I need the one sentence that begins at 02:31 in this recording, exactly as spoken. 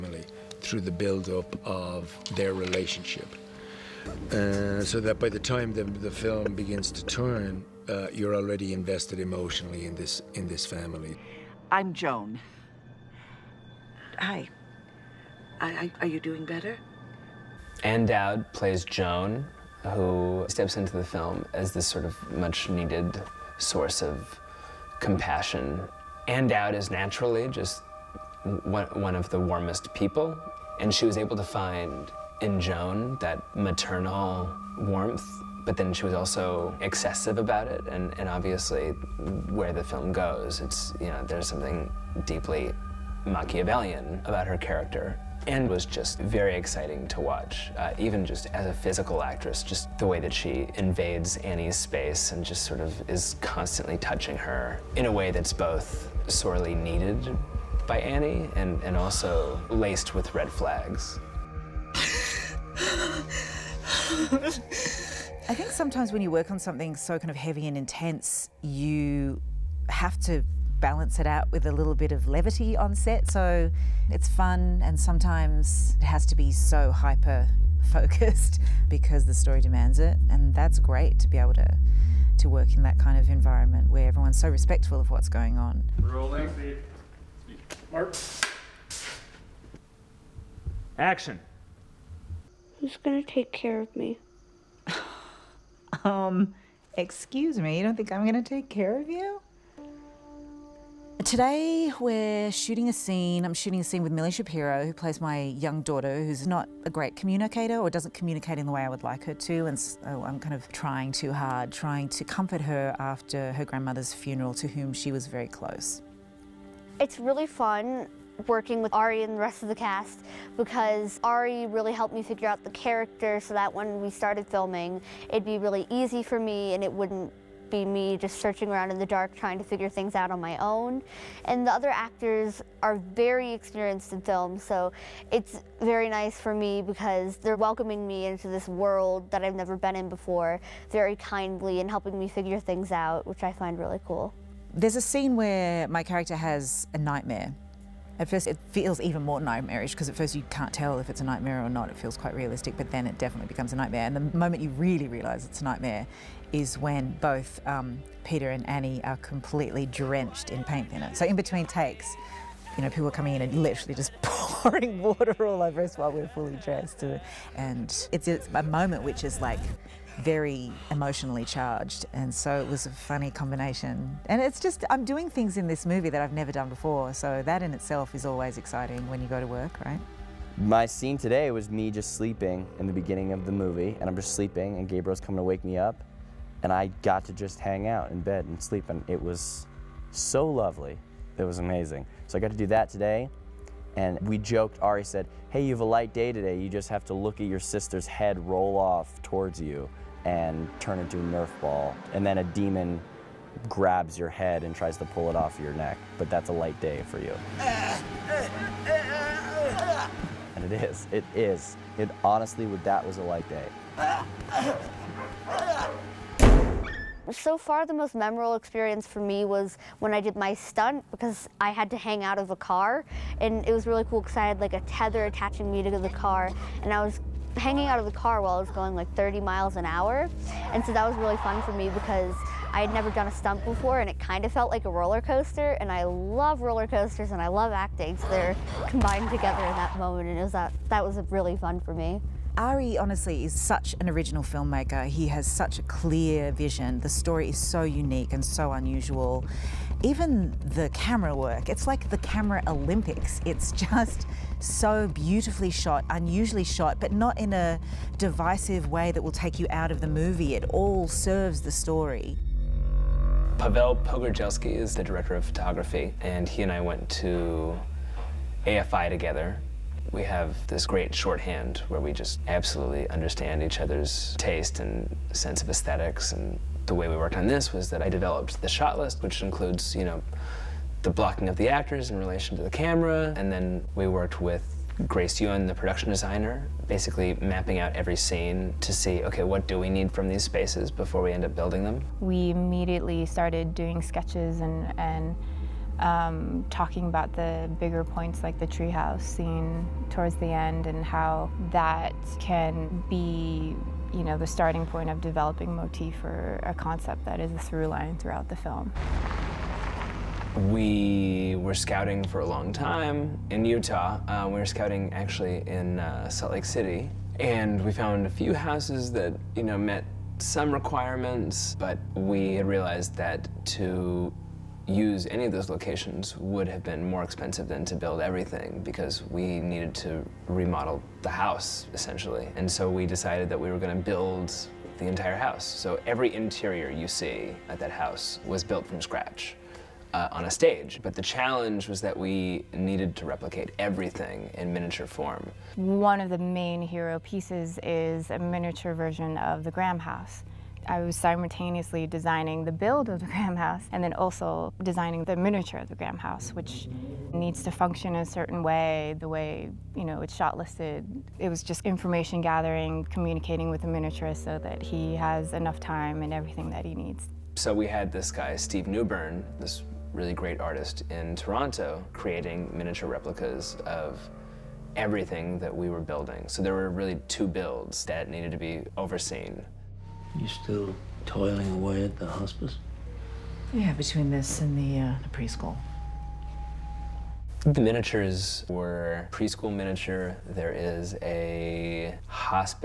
It feels quite realistic, but then it definitely becomes a nightmare.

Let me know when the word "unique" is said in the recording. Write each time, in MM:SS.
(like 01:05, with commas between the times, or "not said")
04:07.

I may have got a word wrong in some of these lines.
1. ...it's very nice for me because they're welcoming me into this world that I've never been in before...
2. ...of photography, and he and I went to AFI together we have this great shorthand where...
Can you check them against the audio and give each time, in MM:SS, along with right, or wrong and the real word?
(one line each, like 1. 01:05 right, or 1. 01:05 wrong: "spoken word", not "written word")
1. 02:15 right
2. 04:25 right.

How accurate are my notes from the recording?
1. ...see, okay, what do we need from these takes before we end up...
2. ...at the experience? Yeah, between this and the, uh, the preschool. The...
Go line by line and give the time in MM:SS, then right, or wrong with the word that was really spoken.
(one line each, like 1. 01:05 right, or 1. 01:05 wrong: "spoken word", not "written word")
1. 04:48 wrong: "spaces", not "takes"
2. 06:22 wrong: "hospice", not "experience".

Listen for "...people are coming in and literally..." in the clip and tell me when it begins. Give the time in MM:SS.
02:42.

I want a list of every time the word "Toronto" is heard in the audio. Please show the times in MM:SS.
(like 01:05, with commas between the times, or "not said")
06:11.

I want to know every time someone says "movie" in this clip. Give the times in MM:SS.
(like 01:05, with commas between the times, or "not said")
02:55, 03:03, 04:20.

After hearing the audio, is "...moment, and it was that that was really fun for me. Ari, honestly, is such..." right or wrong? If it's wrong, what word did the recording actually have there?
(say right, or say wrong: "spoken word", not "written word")
right.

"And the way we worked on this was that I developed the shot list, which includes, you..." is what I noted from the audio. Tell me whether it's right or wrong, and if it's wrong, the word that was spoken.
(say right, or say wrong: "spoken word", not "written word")
right.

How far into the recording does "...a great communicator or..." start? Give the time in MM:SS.
01:46.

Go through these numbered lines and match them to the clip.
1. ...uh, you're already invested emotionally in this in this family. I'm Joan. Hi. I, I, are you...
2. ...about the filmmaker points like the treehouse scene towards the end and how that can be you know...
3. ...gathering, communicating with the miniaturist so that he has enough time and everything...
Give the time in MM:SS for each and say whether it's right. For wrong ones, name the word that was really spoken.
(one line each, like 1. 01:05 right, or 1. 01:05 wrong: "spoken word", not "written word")
1. 00:07 right
2. 04:57 wrong: "bigger", not "filmmaker"
3. 06:02 right.